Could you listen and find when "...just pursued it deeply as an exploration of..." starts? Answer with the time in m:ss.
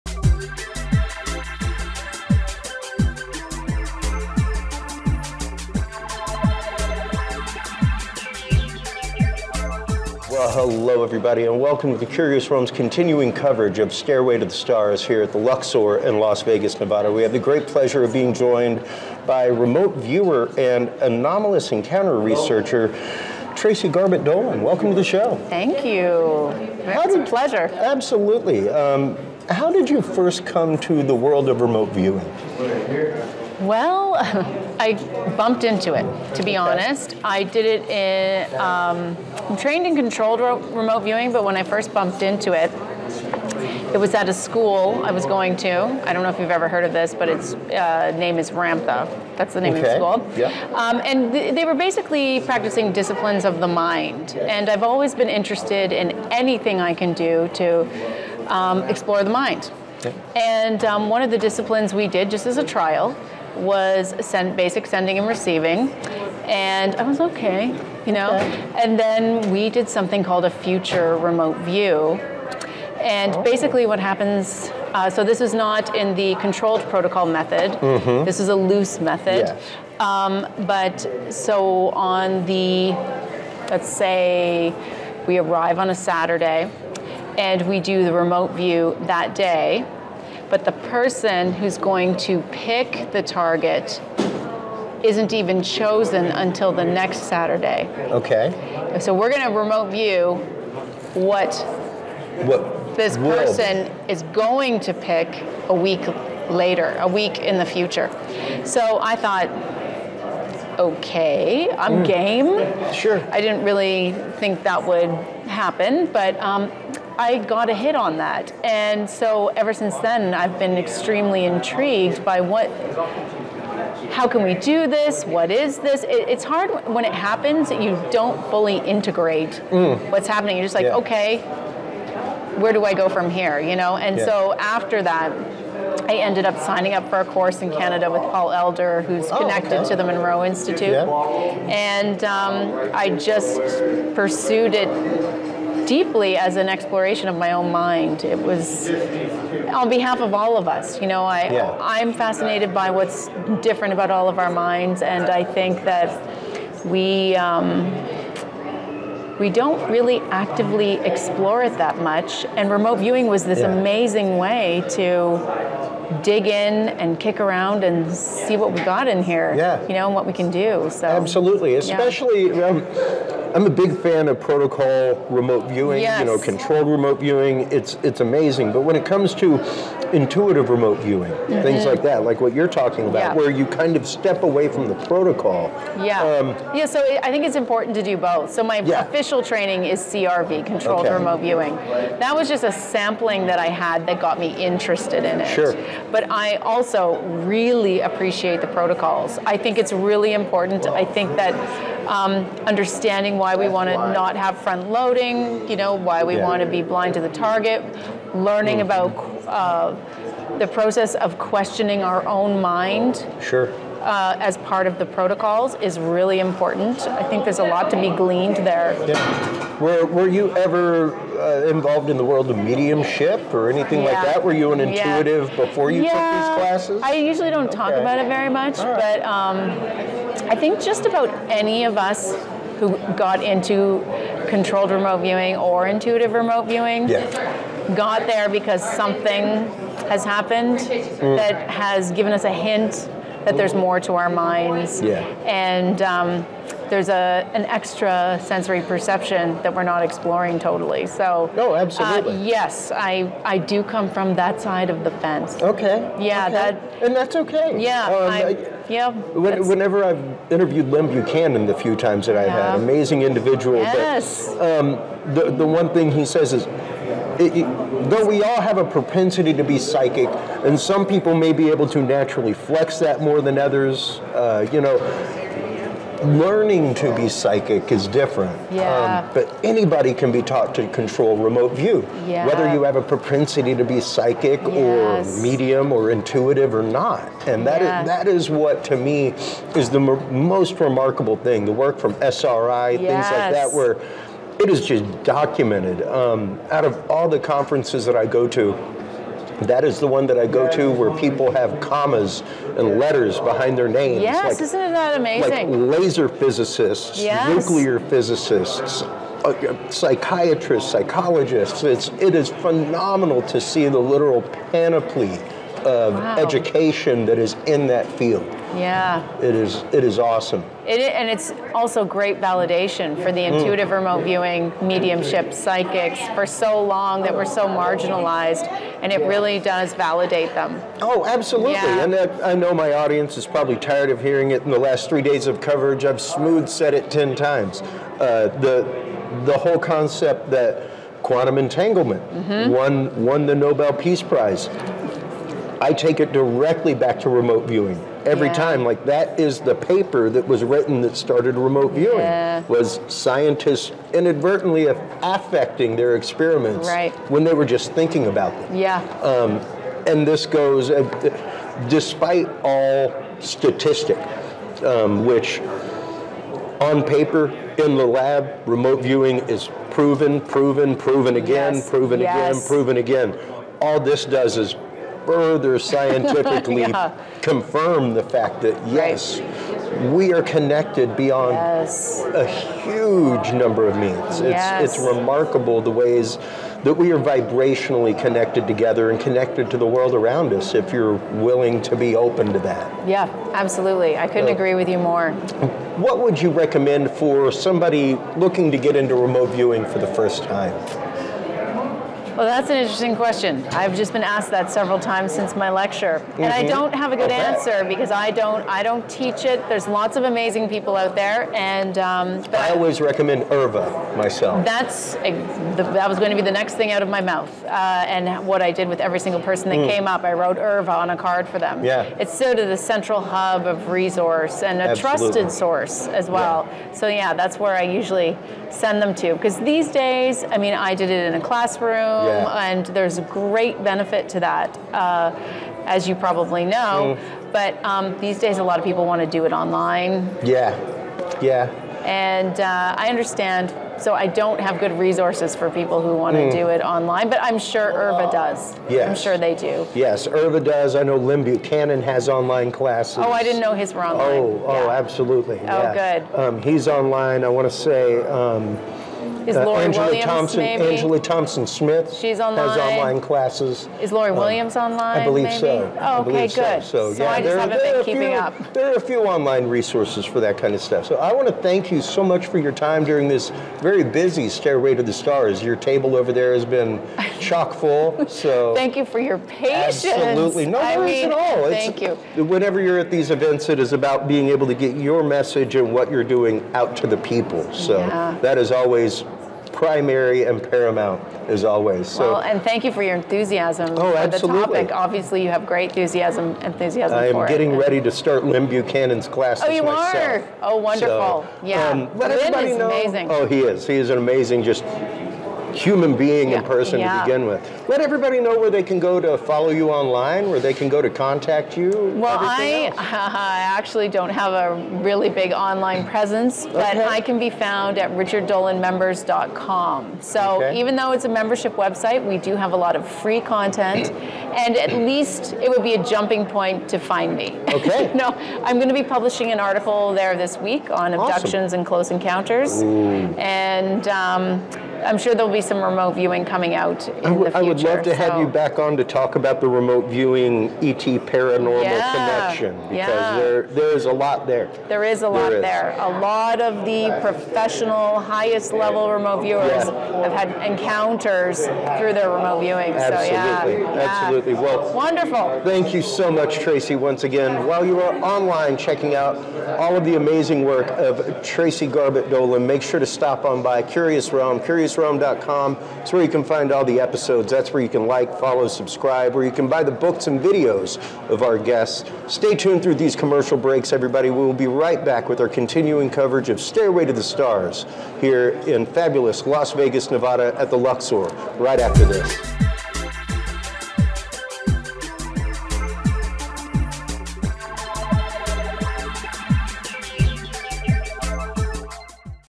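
2:23.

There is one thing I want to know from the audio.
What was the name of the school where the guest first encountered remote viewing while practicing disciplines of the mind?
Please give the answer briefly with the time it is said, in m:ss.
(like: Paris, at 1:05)
Ramtha, at 0:48.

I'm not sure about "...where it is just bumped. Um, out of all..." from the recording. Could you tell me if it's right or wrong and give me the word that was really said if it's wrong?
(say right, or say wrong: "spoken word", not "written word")
wrong: "documented", not "bumped".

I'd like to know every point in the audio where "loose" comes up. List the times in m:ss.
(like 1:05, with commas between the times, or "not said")
1:18.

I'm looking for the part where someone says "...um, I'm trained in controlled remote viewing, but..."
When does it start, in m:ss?
0:38.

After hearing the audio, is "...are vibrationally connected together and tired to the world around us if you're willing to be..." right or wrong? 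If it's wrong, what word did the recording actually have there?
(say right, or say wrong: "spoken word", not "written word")
wrong: "connected", not "tired".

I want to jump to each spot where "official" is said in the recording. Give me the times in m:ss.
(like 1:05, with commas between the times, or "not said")
3:09.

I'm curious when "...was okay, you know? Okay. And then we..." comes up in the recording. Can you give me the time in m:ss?
1:07.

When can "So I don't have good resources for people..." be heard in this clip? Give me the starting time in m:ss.
7:24.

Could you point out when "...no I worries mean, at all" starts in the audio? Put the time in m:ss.
8:00.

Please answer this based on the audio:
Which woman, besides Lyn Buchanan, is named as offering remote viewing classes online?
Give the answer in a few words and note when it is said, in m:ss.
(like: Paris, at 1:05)
Angela Thompson Smith, at 7:40.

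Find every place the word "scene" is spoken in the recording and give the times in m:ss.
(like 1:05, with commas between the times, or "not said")
not said.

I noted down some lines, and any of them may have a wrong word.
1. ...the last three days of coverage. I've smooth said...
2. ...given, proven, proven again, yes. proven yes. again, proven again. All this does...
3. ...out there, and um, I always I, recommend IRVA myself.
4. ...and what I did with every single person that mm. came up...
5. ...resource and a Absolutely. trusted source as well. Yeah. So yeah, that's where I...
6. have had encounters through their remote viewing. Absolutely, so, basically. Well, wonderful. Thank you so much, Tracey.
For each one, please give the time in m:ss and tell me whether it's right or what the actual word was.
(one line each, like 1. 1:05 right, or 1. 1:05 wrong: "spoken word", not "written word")
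1. 5:34 right
2. 6:09 wrong: "proven", not "given"
3. 6:51 right
4. 6:58 right
5. 7:04 right
6. 9:10 wrong: "absolutely", not "basically".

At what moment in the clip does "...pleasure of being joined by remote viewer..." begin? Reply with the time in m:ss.
0:17.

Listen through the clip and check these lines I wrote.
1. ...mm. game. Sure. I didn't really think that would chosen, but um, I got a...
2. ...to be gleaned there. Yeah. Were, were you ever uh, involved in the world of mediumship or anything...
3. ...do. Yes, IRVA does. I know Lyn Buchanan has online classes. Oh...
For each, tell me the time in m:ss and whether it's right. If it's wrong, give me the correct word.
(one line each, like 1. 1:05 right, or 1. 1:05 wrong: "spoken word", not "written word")
1. 1:52 wrong: "happen", not "chosen"
2. 3:37 right
3. 7:29 right.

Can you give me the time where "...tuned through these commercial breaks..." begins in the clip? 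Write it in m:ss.
9:32.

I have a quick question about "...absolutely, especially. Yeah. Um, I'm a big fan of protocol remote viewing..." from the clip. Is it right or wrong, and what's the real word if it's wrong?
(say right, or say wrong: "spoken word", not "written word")
right.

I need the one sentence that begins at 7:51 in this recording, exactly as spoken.
So I want to thank you so much for your time during this very busy Stairway to the Stars.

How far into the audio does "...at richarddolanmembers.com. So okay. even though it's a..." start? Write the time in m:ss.
8:37.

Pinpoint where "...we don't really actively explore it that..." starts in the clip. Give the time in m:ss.
2:39.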